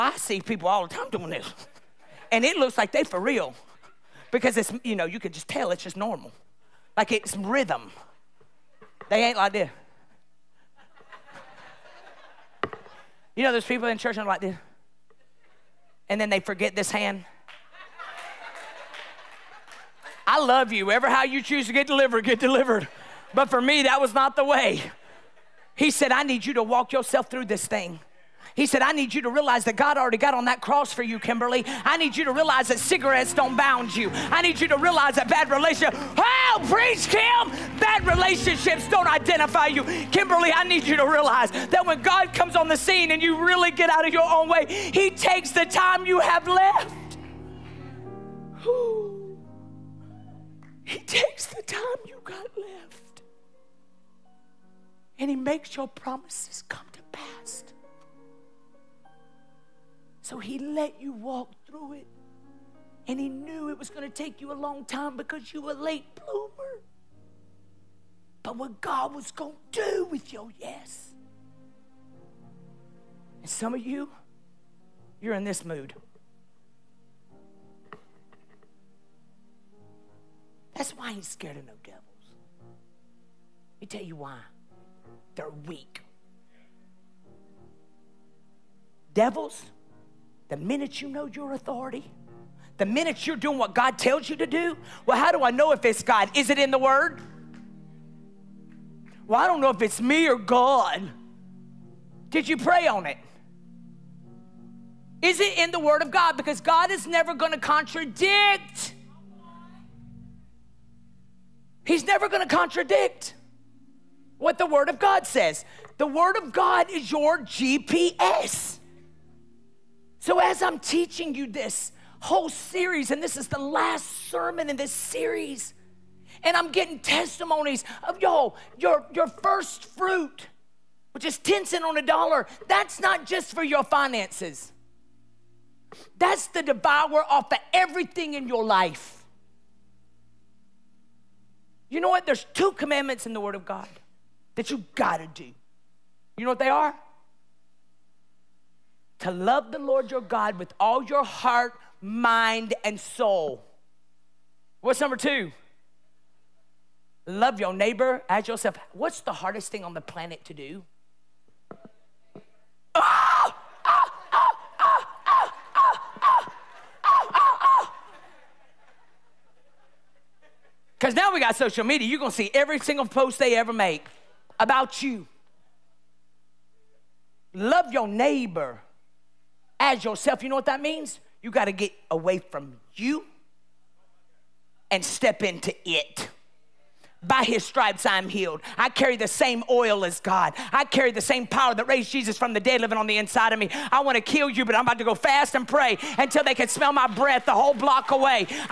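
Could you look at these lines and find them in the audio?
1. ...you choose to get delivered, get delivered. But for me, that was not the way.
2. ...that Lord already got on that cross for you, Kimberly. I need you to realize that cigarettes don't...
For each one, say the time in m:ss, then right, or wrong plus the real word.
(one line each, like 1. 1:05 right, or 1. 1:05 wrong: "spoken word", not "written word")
1. 0:21 right
2. 0:29 wrong: "God", not "Lord".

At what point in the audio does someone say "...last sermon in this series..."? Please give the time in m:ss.
2:03.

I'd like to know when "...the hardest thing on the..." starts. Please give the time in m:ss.
2:39.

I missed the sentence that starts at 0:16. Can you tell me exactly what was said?
And then they forget this hand.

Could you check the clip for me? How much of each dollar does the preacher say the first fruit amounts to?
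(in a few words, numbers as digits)
10 cents.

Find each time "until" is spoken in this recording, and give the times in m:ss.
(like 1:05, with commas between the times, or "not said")
3:16.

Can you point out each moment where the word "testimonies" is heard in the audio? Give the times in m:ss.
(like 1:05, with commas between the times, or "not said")
2:06.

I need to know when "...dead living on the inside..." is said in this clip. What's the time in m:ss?
3:12.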